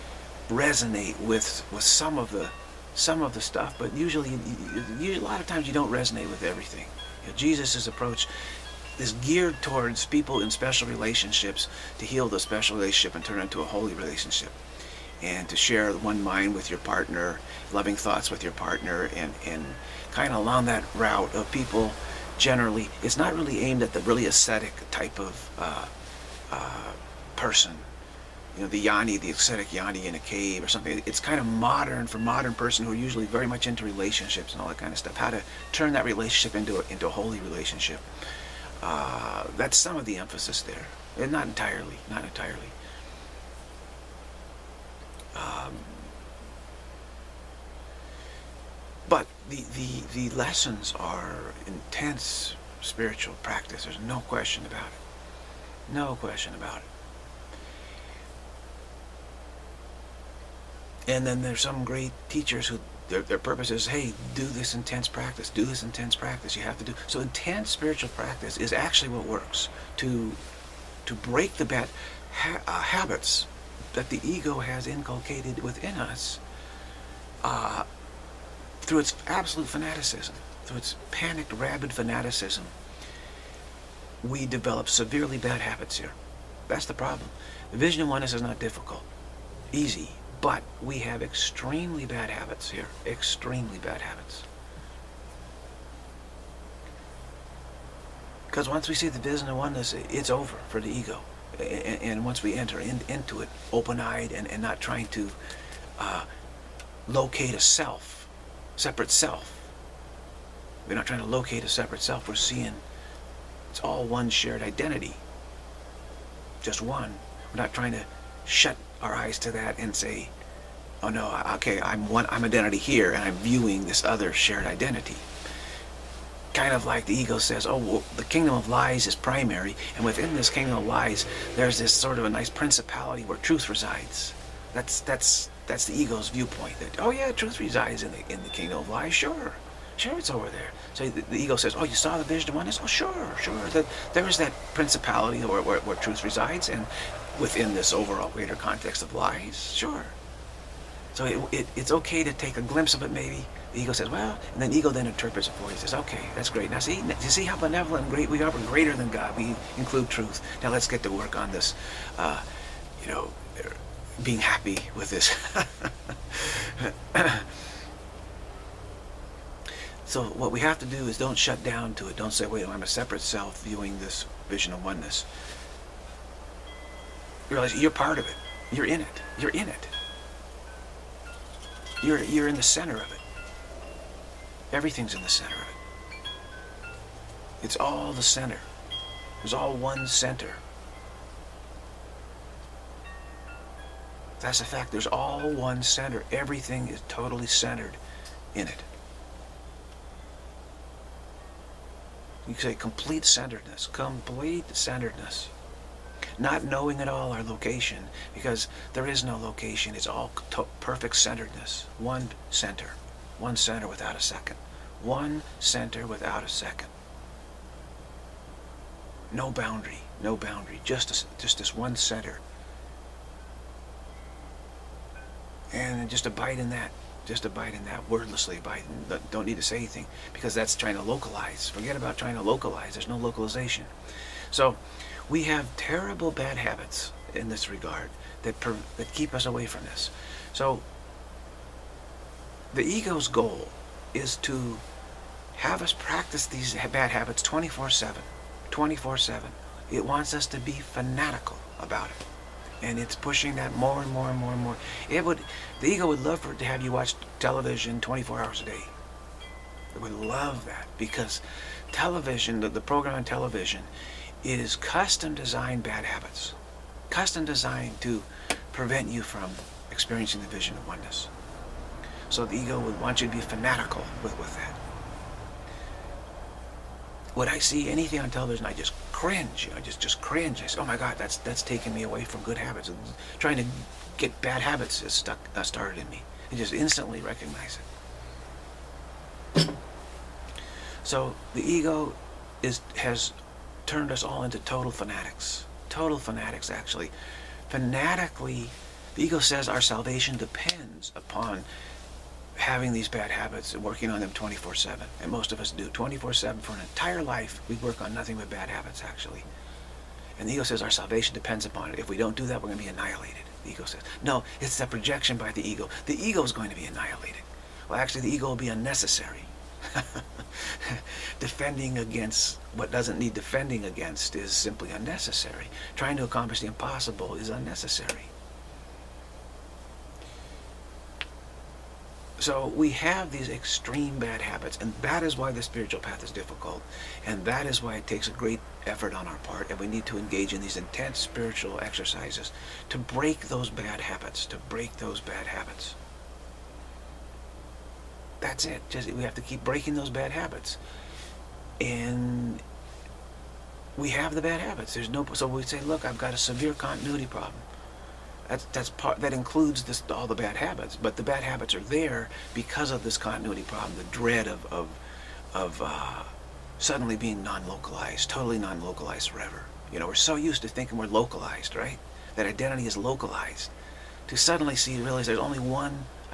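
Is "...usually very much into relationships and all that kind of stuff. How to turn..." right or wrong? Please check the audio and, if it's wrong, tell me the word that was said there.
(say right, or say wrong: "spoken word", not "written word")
right.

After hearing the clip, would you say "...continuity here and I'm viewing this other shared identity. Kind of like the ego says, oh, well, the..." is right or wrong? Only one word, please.
wrong.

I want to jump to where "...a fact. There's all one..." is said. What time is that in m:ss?
3:14.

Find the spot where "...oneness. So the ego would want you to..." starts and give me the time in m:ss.
4:30.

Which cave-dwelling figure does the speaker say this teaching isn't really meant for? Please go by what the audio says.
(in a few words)
ascetic yogi.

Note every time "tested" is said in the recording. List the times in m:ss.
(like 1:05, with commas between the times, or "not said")
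not said.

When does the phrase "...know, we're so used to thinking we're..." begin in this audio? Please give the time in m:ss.
6:09.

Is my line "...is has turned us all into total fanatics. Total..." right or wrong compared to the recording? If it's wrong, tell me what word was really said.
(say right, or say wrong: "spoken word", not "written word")
right.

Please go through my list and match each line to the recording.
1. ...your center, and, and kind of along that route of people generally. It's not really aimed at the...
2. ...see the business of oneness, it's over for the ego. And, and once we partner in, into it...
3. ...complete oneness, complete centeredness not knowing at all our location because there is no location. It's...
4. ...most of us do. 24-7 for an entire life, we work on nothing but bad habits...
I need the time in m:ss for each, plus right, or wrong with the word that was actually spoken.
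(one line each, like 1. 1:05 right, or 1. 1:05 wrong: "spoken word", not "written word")
1. 0:18 wrong: "partner", not "center"
2. 1:38 wrong: "enter", not "partner"
3. 3:22 wrong: "centeredness", not "oneness"
4. 5:05 right.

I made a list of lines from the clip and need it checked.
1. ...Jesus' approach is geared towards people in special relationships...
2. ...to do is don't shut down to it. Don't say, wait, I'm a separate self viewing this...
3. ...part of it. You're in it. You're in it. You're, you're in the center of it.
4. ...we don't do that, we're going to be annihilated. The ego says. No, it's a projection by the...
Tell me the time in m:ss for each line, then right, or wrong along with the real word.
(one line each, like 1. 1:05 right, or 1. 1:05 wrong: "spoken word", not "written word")
1. 0:07 right
2. 2:50 right
3. 2:57 right
4. 5:12 right.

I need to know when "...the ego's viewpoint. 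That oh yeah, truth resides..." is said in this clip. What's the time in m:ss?
2:15.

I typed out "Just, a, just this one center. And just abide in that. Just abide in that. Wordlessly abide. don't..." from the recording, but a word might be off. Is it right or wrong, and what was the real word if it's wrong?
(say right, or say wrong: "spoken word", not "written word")
right.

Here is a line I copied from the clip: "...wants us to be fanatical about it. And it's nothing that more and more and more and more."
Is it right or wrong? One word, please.
wrong.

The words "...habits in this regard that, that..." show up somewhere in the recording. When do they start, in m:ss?
3:56.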